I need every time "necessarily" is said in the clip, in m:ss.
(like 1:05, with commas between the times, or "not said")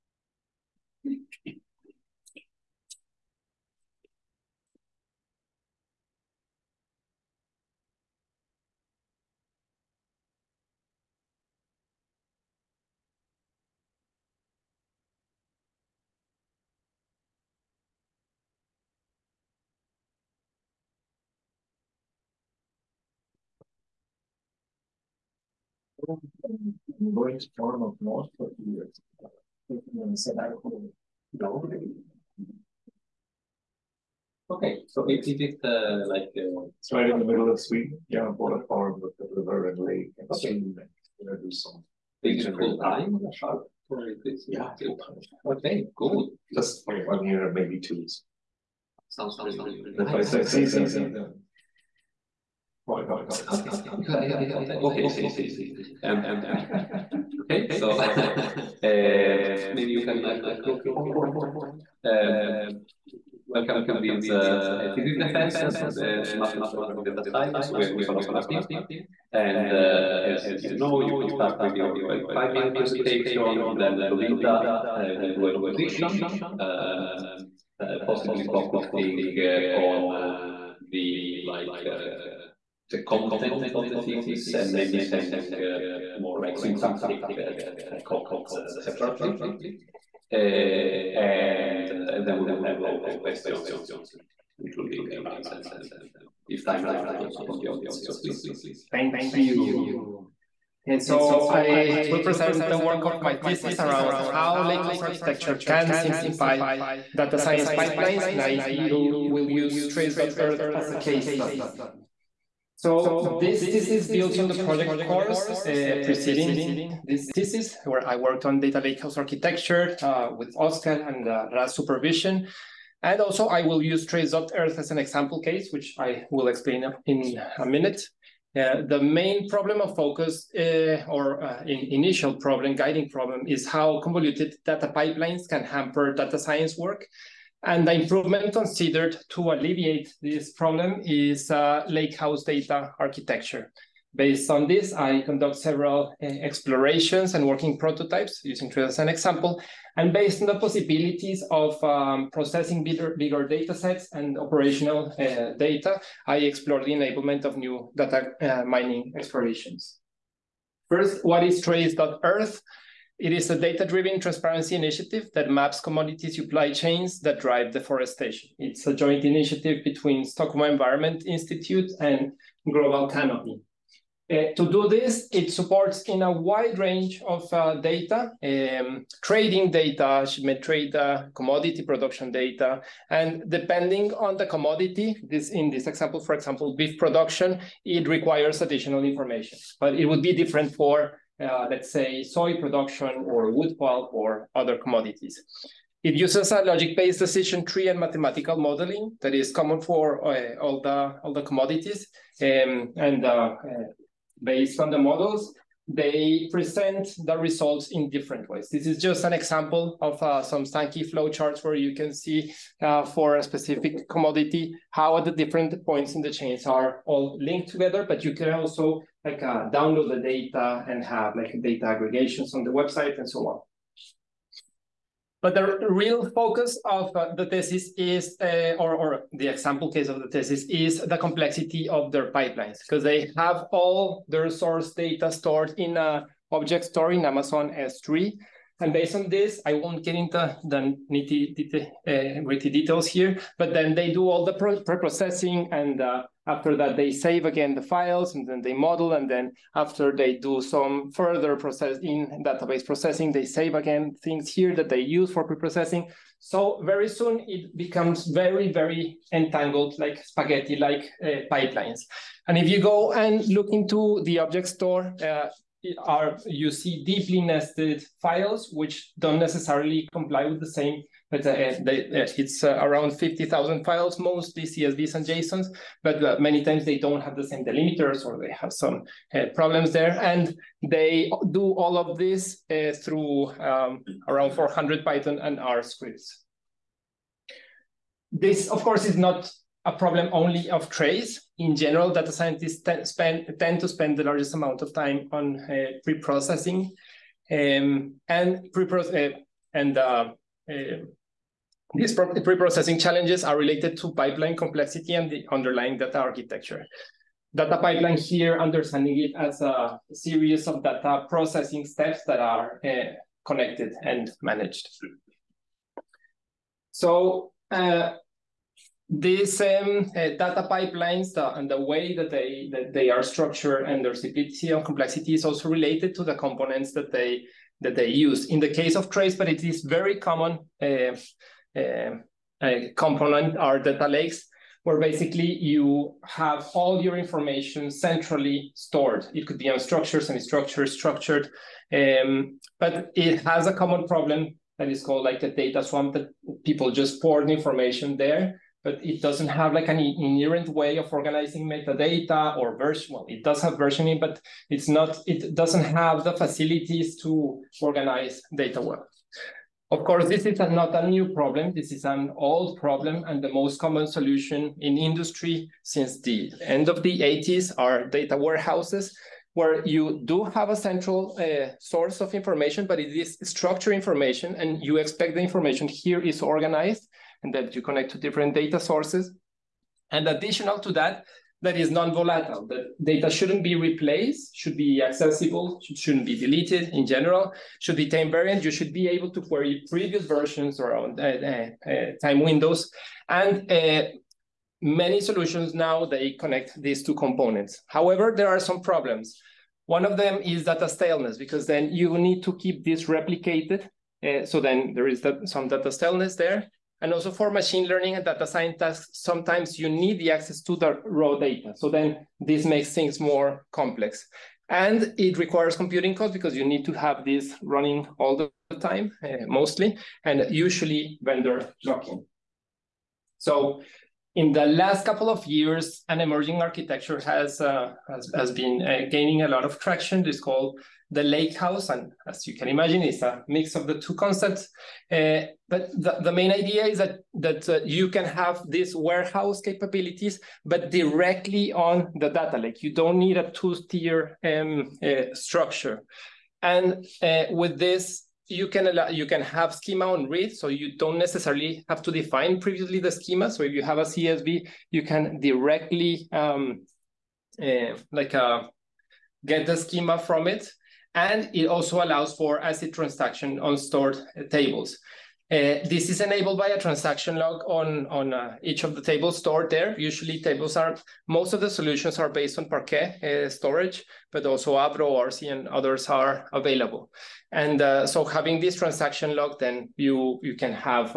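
4:29, 7:31.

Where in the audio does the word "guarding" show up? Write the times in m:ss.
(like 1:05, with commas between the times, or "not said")
not said.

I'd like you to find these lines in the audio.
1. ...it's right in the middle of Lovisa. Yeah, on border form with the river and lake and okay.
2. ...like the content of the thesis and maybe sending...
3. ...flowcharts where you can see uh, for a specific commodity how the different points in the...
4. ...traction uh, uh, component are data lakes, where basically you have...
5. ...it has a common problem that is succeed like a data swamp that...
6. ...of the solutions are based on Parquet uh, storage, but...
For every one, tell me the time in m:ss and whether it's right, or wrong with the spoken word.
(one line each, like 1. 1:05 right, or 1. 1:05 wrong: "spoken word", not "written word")
1. 0:36 wrong: "Sweden", not "Lovisa"
2. 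1:21 right
3. 3:30 right
4. 5:30 wrong: "common", not "traction"
5. 5:43 wrong: "called", not "succeed"
6. 7:51 right.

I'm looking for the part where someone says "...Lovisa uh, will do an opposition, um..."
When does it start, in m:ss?
1:14.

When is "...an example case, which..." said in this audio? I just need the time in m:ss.
2:04.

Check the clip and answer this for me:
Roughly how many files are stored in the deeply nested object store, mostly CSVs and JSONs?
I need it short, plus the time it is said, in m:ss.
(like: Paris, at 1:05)
50,000, at 4:33.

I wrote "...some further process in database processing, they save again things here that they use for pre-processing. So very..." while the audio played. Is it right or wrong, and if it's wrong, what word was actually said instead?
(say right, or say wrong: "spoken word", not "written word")
right.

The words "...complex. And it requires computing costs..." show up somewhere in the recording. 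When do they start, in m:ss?
6:53.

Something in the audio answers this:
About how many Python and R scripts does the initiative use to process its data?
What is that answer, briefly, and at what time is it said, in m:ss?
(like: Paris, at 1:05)
400, at 4:44.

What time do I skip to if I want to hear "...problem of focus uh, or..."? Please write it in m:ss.
2:09.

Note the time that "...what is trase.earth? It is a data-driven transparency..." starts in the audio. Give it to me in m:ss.
2:41.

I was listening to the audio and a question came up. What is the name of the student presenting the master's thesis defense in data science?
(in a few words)
Nicolas Martin.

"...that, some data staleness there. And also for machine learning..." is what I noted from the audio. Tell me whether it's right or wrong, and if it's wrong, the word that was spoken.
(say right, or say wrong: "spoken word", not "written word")
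right.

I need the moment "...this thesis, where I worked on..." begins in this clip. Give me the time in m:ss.
1:57.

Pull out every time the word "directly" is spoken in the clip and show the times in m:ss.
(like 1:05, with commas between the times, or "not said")
7:20, 7:35.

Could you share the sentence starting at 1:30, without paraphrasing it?
and, and then we will have open questions, including rounds and if time allows also from the audience.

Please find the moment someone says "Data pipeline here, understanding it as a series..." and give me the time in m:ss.
5:07.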